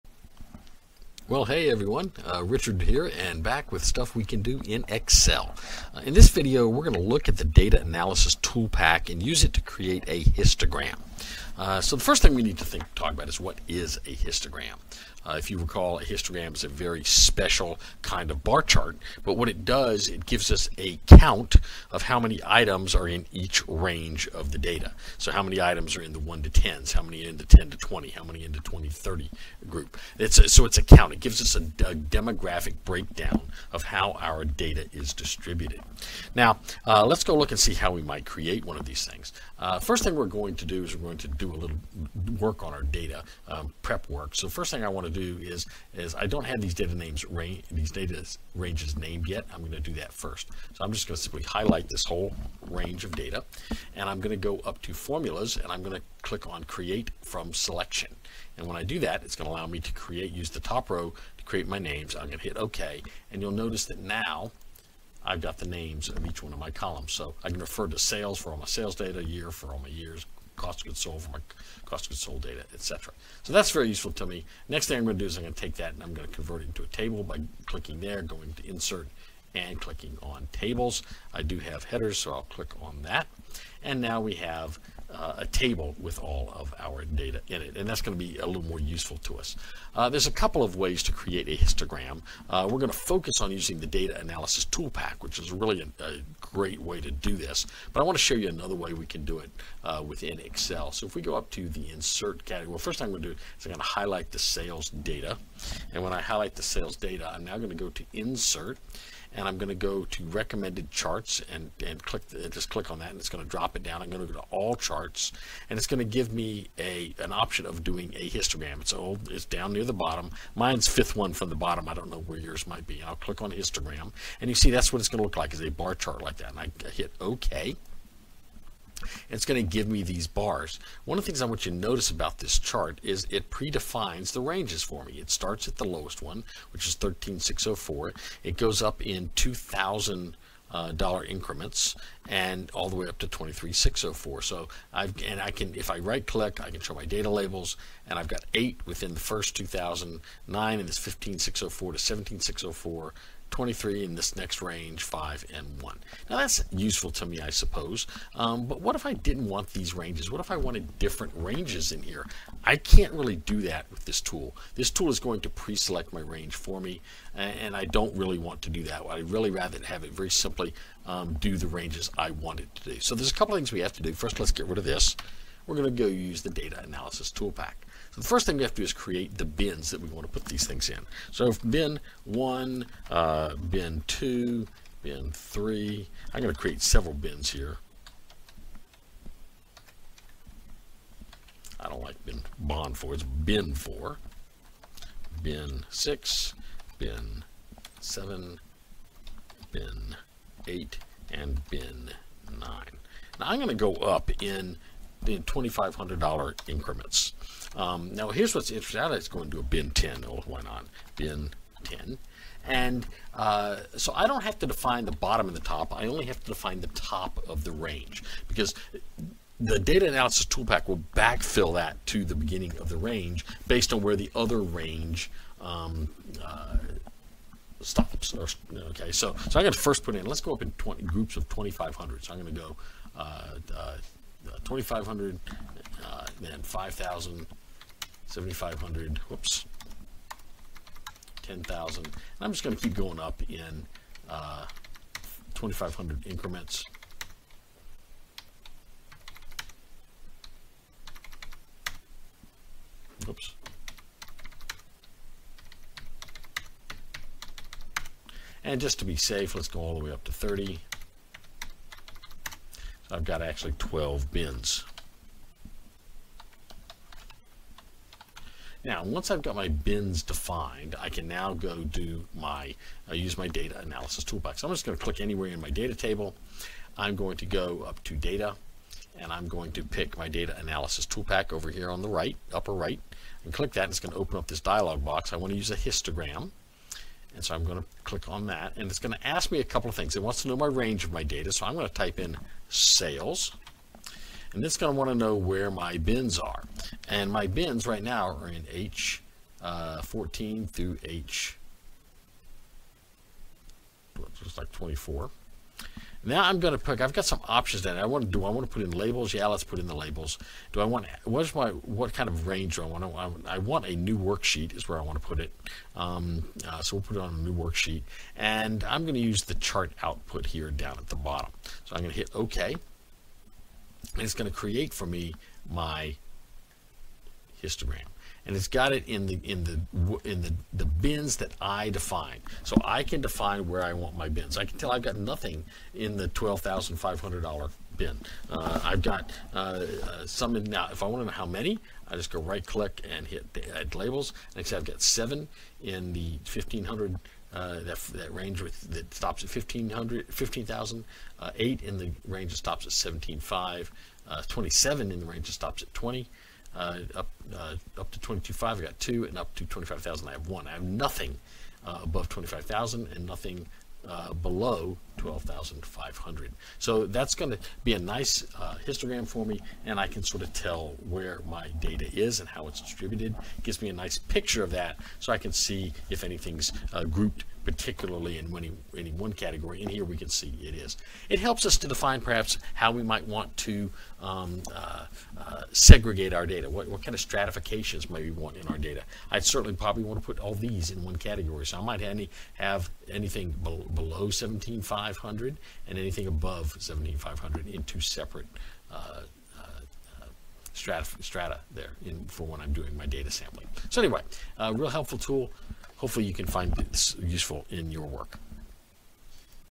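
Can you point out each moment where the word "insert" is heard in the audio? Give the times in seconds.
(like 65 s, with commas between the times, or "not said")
78 s, 101 s, 108 s.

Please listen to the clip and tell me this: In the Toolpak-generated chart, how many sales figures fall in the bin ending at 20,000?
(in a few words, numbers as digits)
27.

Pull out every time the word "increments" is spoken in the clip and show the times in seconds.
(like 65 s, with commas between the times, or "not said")
141 s, 206 s, 246 s.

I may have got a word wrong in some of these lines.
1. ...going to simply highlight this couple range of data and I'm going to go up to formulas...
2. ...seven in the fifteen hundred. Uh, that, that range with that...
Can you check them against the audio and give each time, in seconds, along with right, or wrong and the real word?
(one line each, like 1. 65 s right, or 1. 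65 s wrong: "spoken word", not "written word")
1. 51 s wrong: "whole", not "couple"
2. 345 s right.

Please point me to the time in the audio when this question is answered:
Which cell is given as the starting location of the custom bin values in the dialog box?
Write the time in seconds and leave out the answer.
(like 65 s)
298 s.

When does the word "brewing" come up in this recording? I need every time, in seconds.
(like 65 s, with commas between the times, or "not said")
not said.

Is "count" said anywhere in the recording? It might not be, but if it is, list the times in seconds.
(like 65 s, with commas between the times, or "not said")
21 s, 30 s.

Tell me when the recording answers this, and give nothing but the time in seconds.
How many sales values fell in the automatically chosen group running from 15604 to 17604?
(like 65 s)
153 s.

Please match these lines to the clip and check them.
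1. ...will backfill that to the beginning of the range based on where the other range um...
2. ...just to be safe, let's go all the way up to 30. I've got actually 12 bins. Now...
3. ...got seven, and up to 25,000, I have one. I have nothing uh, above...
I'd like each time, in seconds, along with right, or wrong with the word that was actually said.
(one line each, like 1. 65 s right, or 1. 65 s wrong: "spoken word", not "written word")
1. 220 s right
2. 258 s right
3. 358 s wrong: "two", not "seven".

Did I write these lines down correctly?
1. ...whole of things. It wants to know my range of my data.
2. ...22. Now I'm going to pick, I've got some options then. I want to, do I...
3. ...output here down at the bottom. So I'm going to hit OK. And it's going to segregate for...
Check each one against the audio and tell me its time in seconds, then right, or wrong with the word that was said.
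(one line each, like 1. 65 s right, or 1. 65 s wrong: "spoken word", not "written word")
1. 289 s wrong: "couple", not "whole"
2. 304 s wrong: "24", not "22"
3. 320 s wrong: "create", not "segregate".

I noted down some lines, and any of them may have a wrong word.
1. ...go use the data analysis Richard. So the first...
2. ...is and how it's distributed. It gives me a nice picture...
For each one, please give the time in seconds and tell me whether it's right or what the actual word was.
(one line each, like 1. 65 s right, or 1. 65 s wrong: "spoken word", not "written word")
1. 176 s wrong: "Toolpak", not "Richard"
2. 372 s right.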